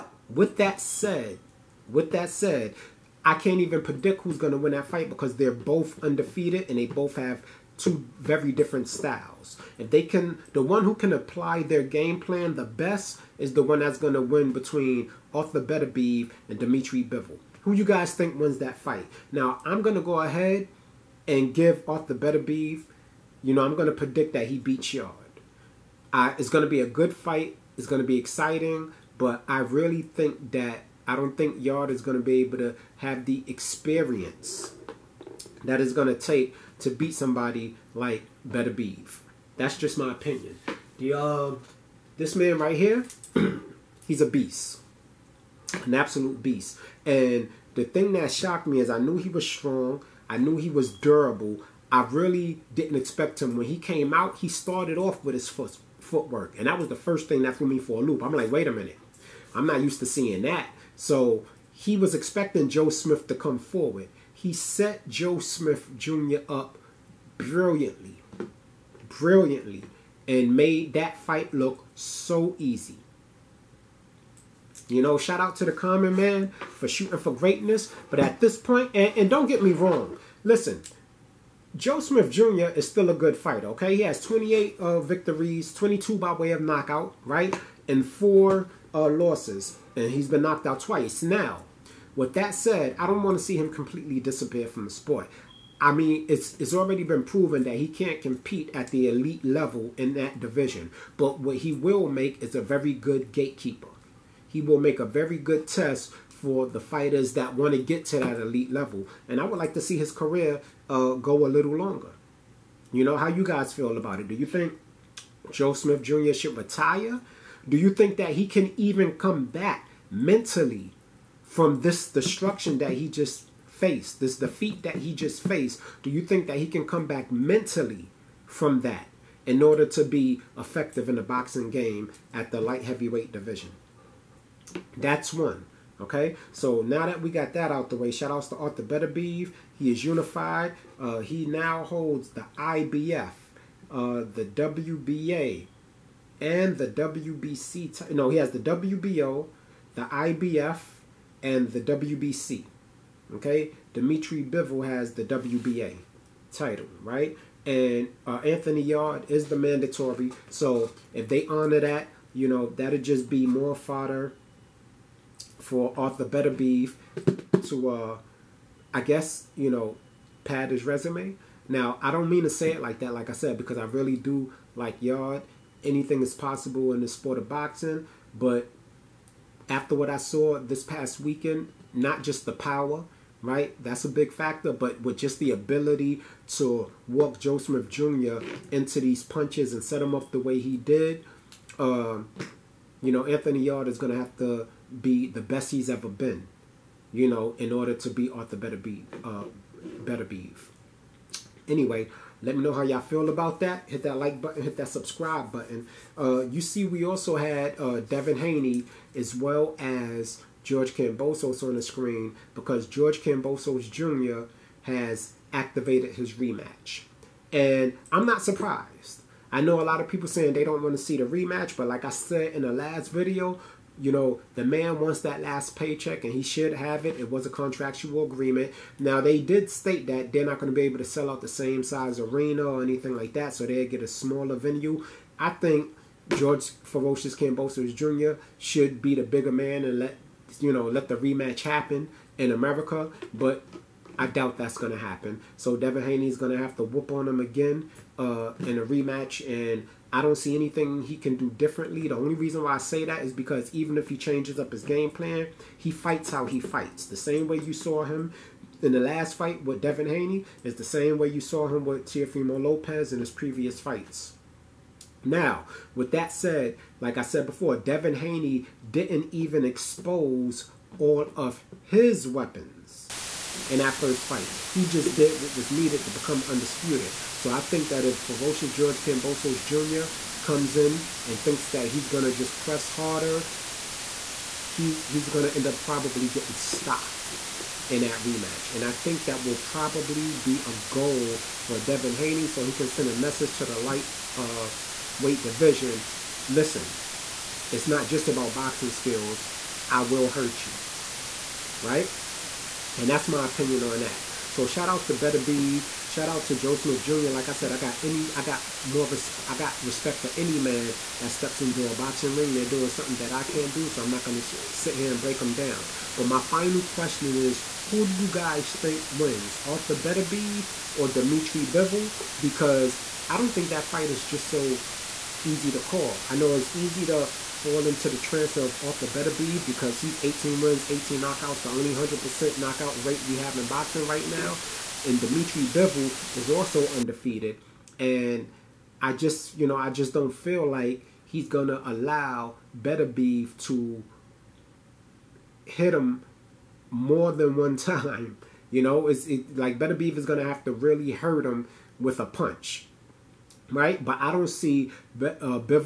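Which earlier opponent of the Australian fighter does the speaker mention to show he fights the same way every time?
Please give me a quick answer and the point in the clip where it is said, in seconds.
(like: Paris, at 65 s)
Teofimo Lopez, at 262 s.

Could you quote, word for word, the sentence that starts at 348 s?
You know, it's it, like Beterbiev is going to have to really hurt him with a punch right?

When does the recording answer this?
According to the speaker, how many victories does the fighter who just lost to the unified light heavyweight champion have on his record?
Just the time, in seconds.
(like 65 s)
84 s.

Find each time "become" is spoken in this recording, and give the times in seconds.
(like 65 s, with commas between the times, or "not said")
276 s.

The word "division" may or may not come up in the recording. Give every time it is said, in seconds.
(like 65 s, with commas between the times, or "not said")
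100 s, 133 s, 295 s.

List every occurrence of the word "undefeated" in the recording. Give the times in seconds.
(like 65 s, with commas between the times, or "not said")
6 s, 336 s.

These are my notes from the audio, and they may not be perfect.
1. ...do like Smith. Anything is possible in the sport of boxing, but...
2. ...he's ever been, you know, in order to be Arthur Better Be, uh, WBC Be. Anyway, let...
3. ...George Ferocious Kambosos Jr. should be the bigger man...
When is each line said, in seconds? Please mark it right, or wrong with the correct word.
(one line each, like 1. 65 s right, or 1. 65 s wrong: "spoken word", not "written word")
1. 174 s wrong: "Yarde", not "Smith"
2. 195 s wrong: "Better", not "WBC"
3. 236 s right.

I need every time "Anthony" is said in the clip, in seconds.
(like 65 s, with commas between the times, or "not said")
158 s, 193 s.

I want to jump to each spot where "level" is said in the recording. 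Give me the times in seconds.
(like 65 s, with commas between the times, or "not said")
99 s, 108 s.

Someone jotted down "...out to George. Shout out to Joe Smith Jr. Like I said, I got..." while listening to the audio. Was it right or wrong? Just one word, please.
wrong.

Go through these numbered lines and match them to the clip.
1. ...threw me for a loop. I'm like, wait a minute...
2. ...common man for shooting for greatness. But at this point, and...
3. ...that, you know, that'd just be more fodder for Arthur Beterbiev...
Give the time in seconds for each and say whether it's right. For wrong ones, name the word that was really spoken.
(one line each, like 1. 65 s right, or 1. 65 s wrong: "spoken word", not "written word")
1. 57 s right
2. 75 s right
3. 161 s right.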